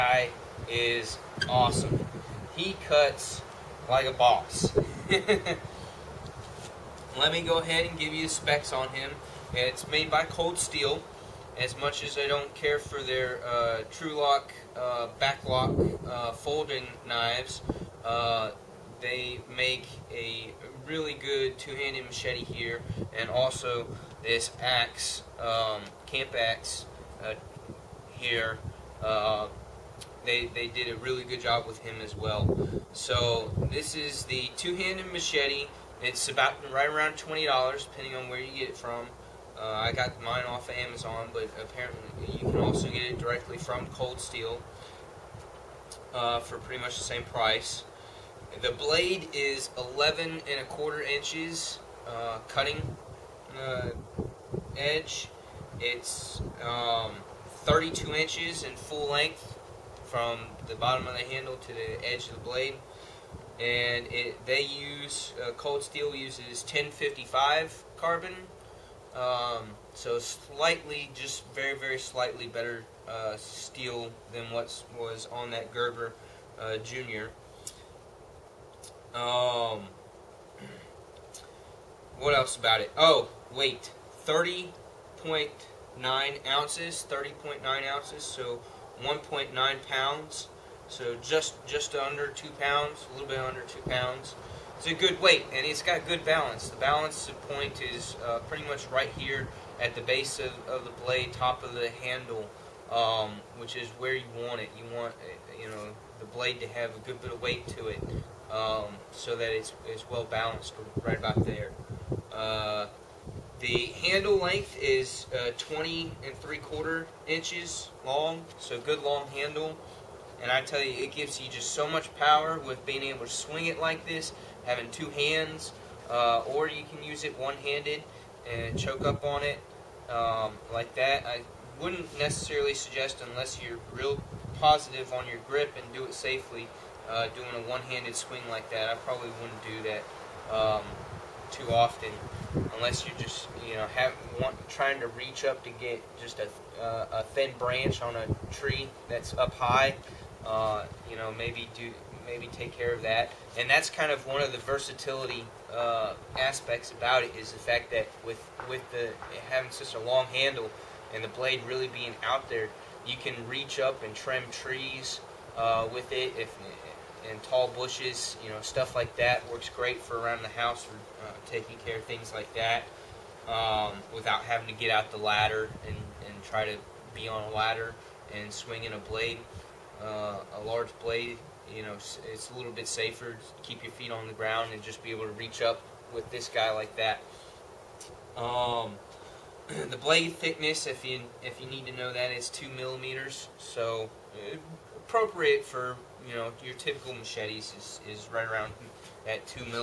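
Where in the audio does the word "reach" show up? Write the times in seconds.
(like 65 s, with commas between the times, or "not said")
145 s, 163 s, 185 s.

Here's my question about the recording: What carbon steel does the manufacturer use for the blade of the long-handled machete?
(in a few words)
1055 carbon.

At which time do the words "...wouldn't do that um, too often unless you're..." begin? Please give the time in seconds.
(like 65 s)
139 s.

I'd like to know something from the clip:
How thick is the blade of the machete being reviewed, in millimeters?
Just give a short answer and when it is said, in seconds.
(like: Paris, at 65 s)
2 millimeters, at 192 s.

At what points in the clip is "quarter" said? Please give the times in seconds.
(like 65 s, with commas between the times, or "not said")
50 s, 116 s.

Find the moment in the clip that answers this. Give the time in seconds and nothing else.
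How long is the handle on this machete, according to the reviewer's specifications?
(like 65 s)
115 s.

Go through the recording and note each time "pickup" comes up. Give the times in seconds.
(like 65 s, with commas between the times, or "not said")
not said.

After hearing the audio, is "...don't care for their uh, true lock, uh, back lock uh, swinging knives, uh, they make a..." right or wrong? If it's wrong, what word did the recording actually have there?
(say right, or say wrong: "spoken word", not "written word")
wrong: "folding", not "swinging".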